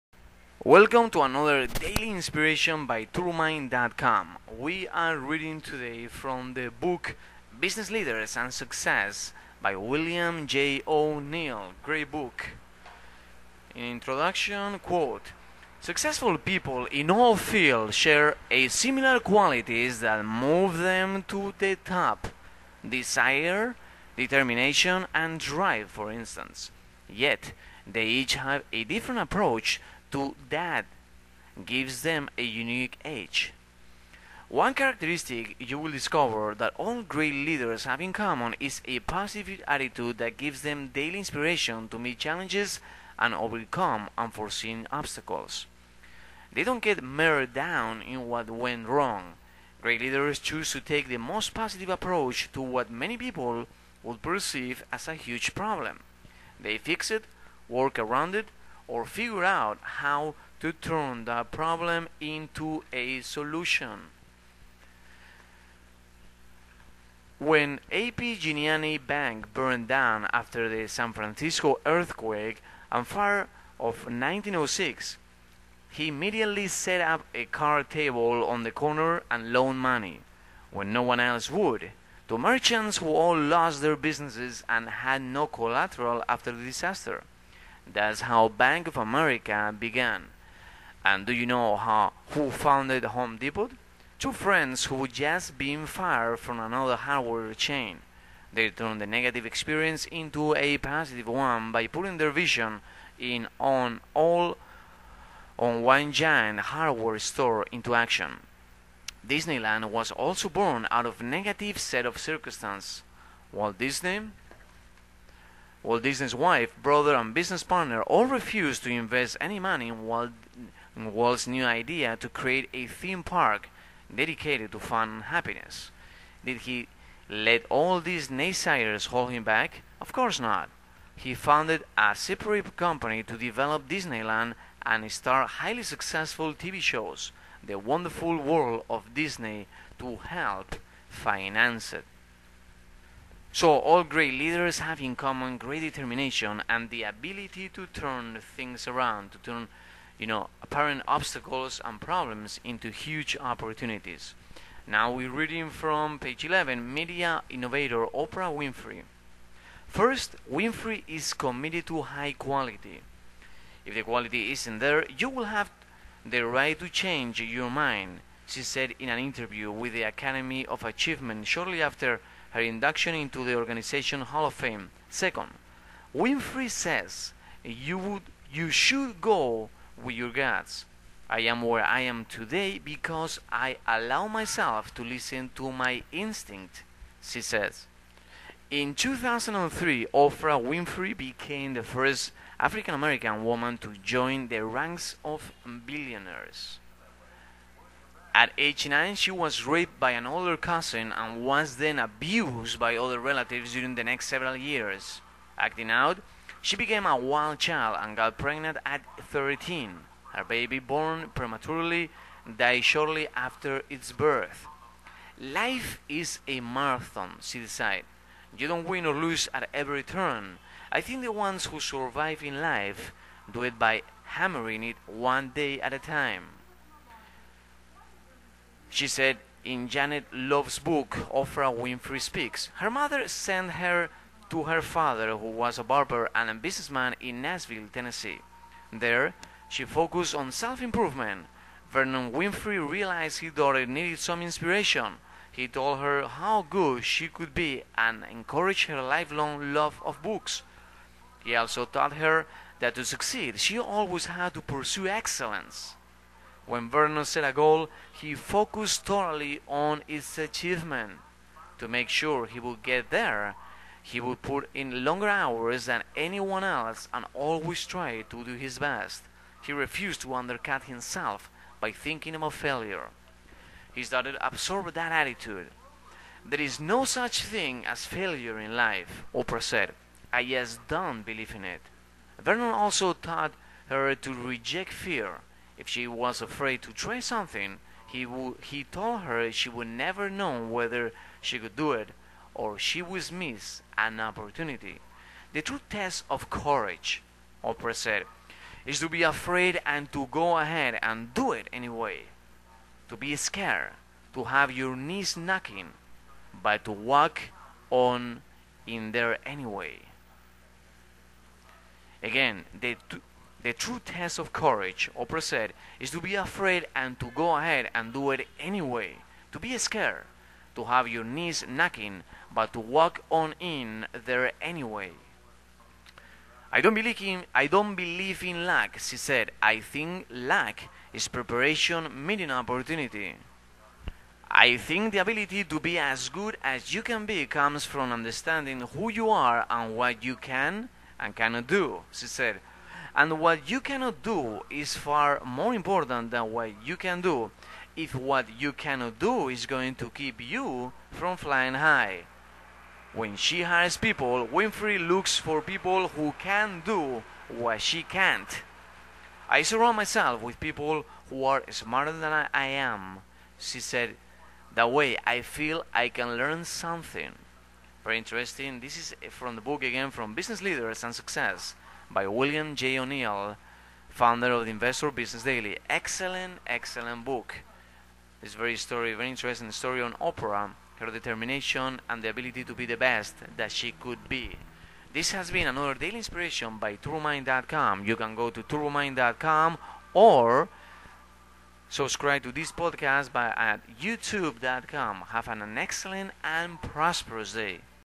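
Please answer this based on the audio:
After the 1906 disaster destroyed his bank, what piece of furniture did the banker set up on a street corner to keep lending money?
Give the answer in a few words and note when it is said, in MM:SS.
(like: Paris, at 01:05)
card table, at 01:17.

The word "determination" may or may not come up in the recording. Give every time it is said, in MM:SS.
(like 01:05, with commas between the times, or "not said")
00:24, 02:25, 06:21.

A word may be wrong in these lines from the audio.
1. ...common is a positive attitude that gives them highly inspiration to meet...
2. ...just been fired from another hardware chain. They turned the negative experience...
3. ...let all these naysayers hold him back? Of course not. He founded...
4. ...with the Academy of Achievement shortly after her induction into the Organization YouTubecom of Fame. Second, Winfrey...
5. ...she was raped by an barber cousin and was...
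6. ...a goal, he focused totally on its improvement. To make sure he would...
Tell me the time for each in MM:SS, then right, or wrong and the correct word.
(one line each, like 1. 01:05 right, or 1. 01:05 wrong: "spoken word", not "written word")
1. 00:38 wrong: "daily", not "highly"
2. 01:35 right
3. 02:07 right
4. 02:49 wrong: "Hall", not "YouTubecom"
5. 03:19 wrong: "older", not "barber"
6. 04:17 wrong: "achievement", not "improvement".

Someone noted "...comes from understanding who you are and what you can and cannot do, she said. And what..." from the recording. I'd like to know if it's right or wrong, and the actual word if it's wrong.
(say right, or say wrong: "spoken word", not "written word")
right.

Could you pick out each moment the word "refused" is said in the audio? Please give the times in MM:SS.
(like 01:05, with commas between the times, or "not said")
01:58, 04:29.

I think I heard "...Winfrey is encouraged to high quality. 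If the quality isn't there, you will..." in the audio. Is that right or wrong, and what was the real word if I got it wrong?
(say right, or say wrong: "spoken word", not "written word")
wrong: "committed", not "encouraged".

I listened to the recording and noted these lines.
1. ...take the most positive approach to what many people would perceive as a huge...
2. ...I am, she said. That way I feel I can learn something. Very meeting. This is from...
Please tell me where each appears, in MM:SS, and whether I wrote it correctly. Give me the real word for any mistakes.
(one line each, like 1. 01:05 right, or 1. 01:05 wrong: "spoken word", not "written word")
1. 00:50 right
2. 06:02 wrong: "interesting", not "meeting".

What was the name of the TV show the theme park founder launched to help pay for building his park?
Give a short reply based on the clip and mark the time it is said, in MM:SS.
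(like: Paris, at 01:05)
The Wonderful World of Disney, at 02:17.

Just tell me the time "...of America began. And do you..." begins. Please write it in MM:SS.
01:28.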